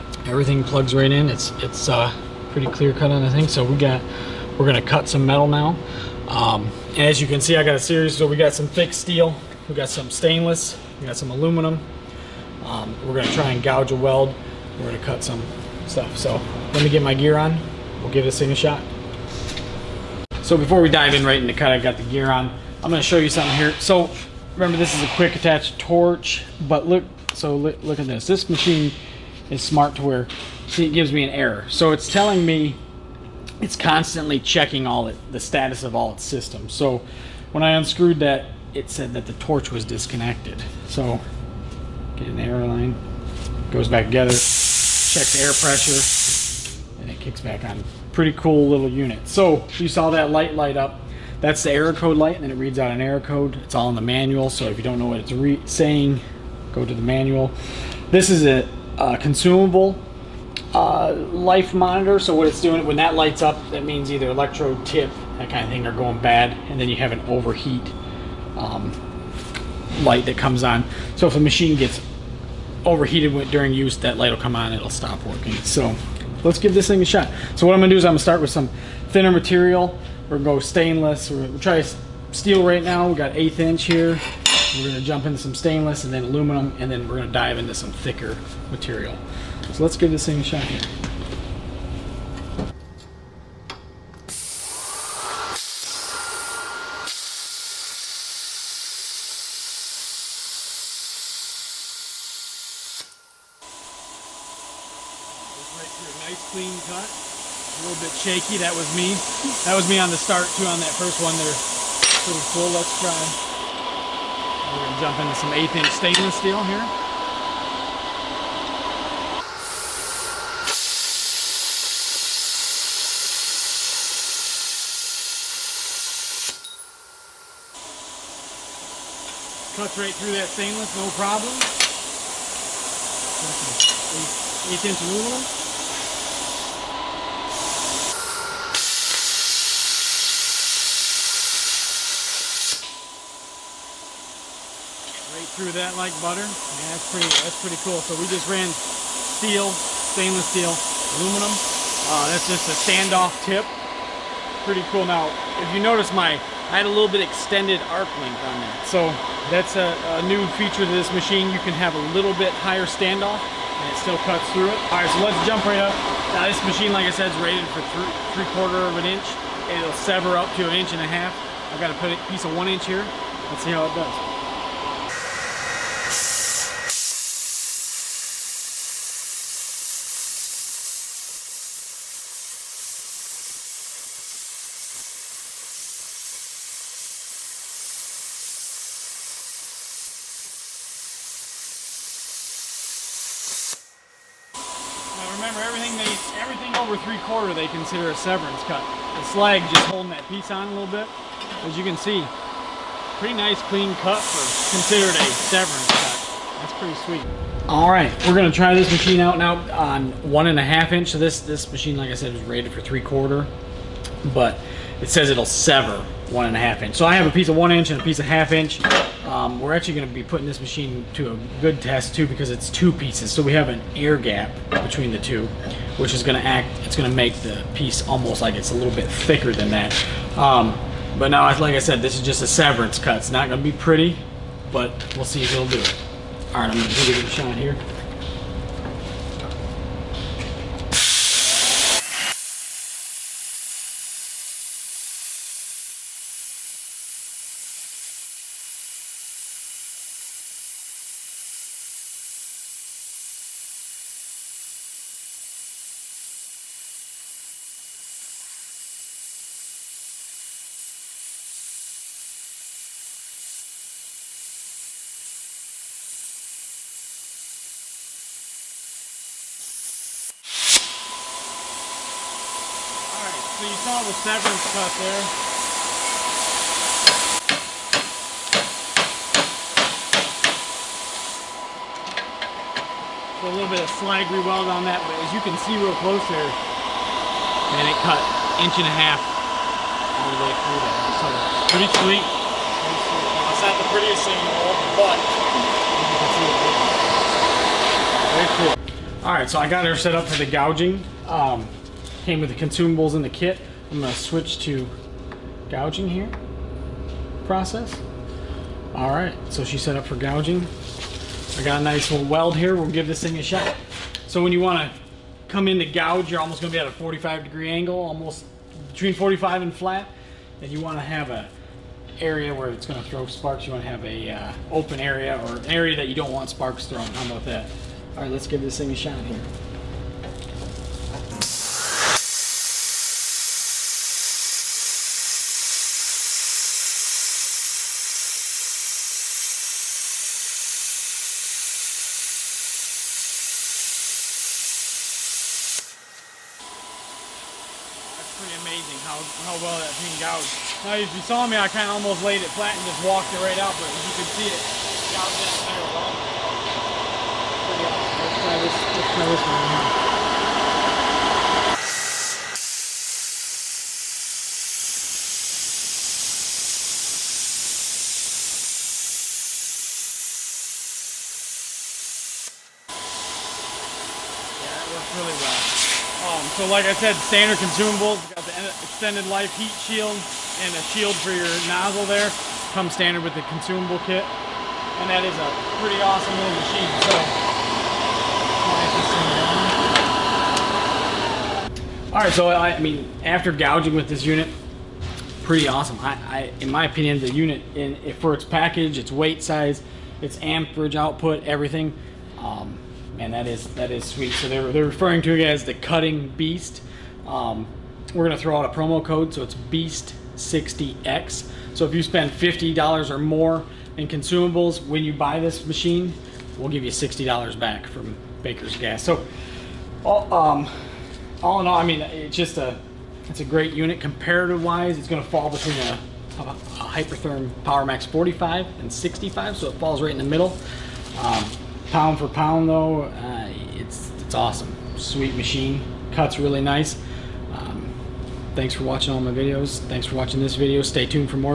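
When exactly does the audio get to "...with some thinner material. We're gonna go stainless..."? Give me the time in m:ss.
1:18.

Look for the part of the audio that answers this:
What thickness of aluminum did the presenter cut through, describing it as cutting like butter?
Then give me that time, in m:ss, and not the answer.
2:11.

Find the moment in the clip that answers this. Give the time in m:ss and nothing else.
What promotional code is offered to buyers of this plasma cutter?
6:49.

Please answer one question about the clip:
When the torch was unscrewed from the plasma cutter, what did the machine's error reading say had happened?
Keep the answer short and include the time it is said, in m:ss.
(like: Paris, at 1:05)
Torch was disconnected, at 0:39.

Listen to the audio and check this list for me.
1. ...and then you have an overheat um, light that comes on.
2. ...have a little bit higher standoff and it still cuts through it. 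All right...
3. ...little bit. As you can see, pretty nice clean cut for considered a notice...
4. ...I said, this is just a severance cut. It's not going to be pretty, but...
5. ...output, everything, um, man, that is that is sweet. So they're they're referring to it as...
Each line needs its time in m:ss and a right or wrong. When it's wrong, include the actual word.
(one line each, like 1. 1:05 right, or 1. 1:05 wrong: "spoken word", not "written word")
1. 1:06 right
2. 2:41 right
3. 3:20 wrong: "severance", not "notice"
4. 3:51 right
5. 6:40 right.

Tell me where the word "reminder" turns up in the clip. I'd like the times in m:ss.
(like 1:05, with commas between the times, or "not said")
not said.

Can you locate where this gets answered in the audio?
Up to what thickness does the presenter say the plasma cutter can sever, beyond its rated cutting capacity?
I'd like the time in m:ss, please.
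2:50.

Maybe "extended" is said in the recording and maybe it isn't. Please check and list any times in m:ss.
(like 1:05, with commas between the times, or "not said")
2:37, 6:18.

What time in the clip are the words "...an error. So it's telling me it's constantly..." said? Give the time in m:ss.
0:31.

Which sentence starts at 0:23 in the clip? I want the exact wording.
So remember, this is a quick attach torch, but look, so look, look at this.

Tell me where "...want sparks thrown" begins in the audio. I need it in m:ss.
5:26.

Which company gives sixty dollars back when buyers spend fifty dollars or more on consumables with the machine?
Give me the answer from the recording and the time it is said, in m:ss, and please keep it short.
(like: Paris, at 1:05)
Baker's Gas, at 6:58.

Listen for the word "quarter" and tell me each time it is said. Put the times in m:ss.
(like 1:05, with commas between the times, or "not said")
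2:48, 3:33.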